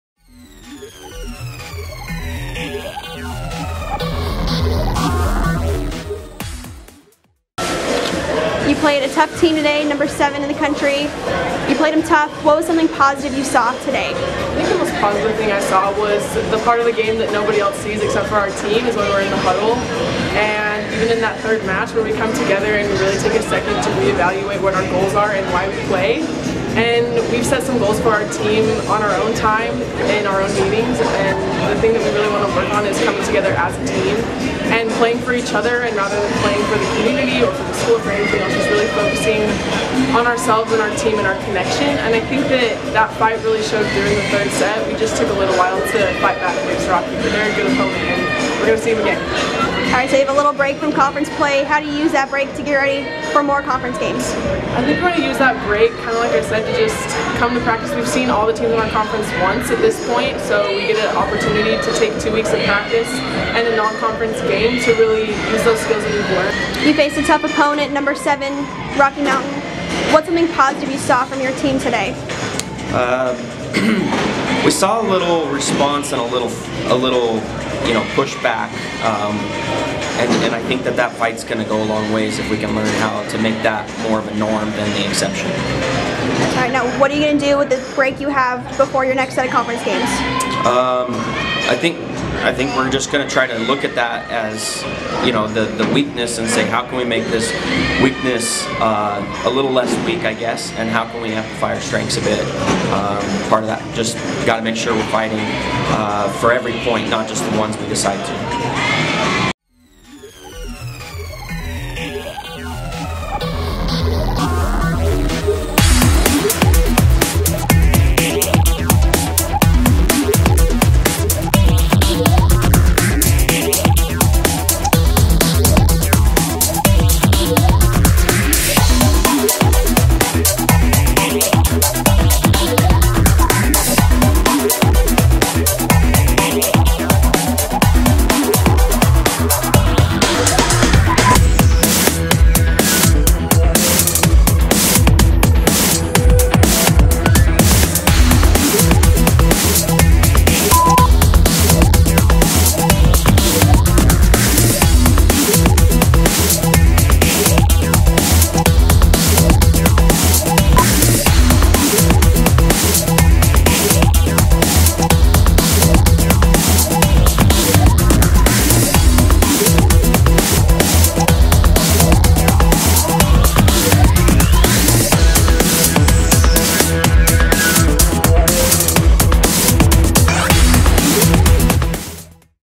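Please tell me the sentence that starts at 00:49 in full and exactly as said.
All right, so you have a little break from conference play.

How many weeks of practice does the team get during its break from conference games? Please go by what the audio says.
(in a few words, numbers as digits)
2.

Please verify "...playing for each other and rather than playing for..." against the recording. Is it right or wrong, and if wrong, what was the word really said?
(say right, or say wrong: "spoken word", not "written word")
right.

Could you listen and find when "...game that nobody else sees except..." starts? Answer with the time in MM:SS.
00:16.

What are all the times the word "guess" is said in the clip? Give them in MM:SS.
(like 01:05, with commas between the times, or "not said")
01:40.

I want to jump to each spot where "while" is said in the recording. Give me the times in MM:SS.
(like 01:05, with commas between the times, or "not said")
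00:45.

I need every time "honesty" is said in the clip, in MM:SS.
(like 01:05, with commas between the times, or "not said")
not said.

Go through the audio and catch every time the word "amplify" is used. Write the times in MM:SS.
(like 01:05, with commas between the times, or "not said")
01:41.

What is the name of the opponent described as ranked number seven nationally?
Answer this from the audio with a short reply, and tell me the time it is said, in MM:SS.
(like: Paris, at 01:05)
Rocky Mountain, at 01:08.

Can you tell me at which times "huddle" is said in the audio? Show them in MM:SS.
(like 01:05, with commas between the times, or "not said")
00:19.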